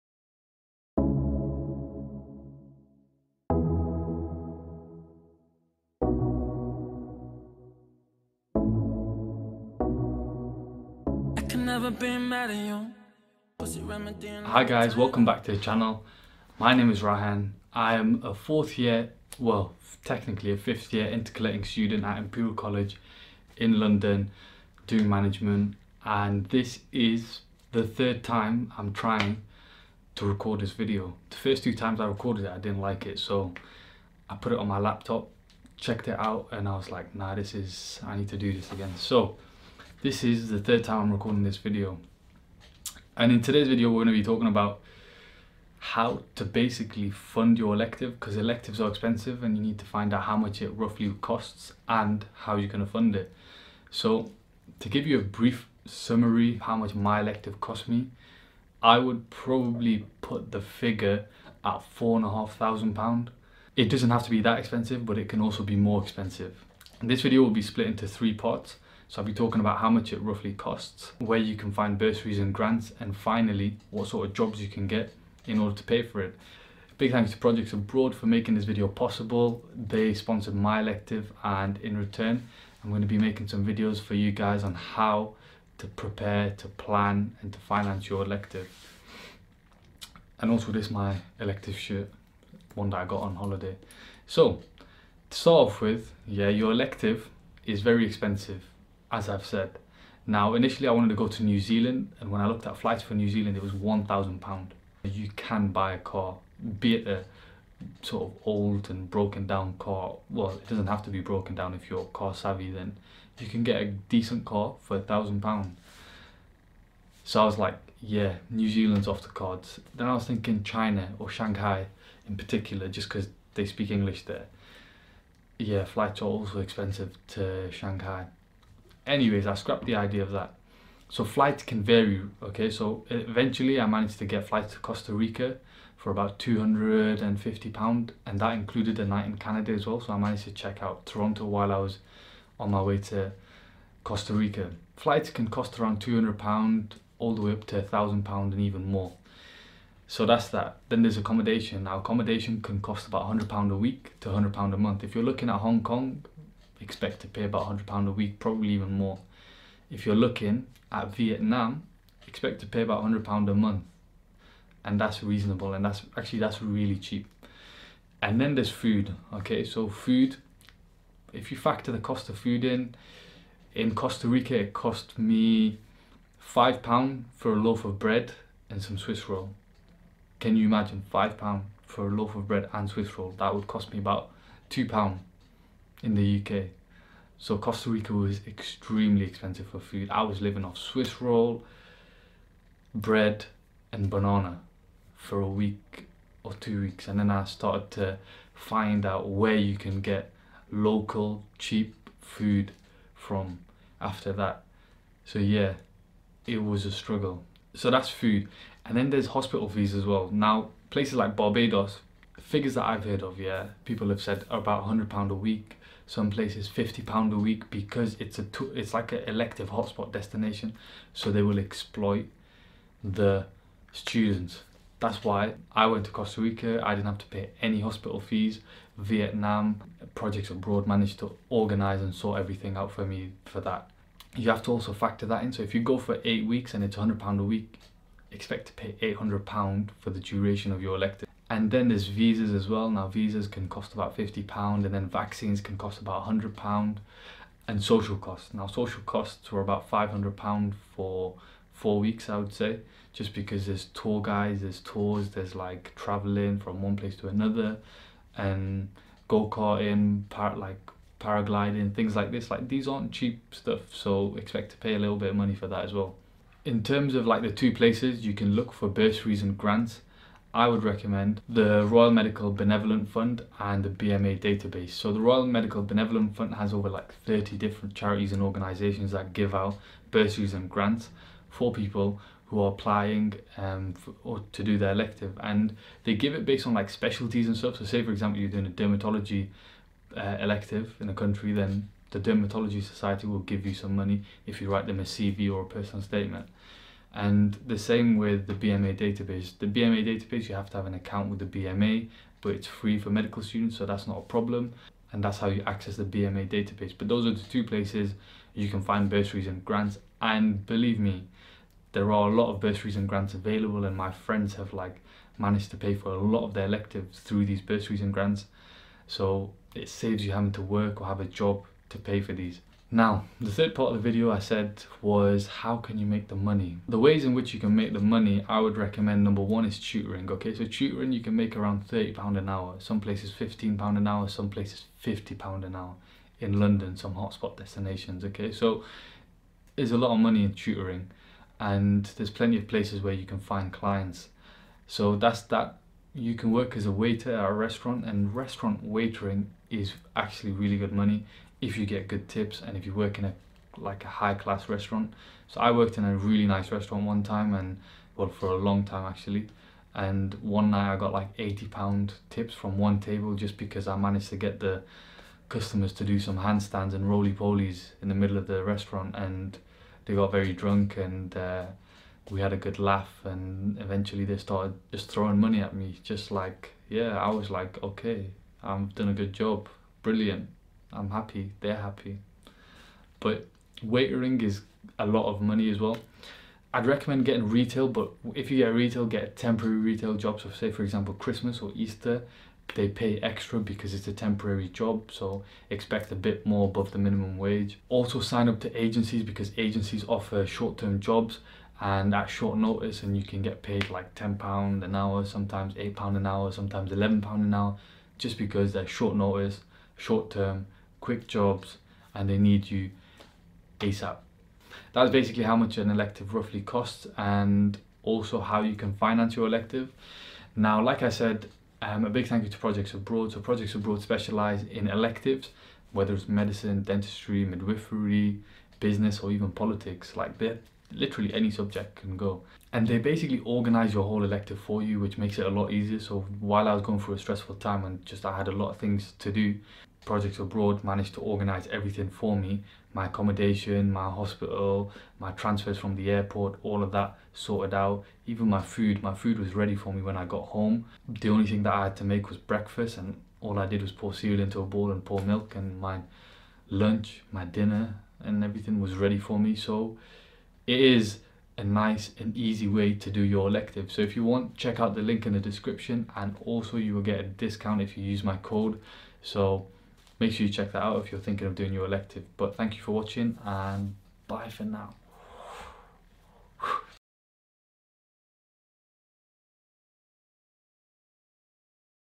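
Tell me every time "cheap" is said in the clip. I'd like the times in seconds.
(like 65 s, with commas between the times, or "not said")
166 s, 201 s, 263 s.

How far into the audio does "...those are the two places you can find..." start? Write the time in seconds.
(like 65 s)
307 s.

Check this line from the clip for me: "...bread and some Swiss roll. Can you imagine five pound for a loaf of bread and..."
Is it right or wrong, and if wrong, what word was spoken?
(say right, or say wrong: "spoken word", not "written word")
right.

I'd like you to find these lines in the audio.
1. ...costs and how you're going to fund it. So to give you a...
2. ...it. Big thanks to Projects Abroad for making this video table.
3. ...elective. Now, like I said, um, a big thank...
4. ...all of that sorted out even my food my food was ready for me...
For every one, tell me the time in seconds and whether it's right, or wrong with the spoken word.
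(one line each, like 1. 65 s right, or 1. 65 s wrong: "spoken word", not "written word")
1. 51 s right
2. 76 s wrong: "possible", not "table"
3. 419 s right
4. 446 s right.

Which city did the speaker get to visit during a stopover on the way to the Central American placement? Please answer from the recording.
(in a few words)
Toronto.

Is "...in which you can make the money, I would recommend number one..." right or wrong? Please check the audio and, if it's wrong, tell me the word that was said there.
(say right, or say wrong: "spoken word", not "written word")
right.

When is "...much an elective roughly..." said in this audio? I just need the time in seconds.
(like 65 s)
415 s.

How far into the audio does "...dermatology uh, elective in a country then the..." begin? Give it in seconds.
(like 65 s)
288 s.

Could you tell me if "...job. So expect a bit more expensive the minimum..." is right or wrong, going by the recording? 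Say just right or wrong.
wrong.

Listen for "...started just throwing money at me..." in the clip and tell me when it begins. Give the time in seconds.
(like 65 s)
374 s.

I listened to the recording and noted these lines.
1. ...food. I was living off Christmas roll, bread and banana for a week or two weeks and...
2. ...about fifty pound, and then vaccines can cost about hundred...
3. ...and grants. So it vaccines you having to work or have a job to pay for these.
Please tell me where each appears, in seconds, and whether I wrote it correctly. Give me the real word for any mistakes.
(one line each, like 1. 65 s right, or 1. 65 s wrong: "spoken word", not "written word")
1. 189 s wrong: "Swiss", not "Christmas"
2. 243 s right
3. 318 s wrong: "saves", not "vaccines".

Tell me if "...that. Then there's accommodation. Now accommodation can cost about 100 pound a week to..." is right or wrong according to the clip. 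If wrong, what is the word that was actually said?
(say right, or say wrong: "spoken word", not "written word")
right.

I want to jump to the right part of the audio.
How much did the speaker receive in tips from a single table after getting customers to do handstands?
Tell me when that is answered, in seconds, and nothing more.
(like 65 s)
361 s.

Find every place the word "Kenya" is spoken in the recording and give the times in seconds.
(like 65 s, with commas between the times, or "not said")
not said.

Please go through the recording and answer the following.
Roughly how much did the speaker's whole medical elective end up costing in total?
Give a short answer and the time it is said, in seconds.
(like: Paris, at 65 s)
£4,500, at 61 s.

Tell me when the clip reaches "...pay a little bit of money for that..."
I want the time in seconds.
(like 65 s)
264 s.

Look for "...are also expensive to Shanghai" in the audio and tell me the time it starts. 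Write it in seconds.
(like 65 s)
126 s.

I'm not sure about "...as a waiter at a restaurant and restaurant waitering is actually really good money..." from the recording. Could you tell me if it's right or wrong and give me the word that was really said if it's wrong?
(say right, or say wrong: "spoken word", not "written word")
right.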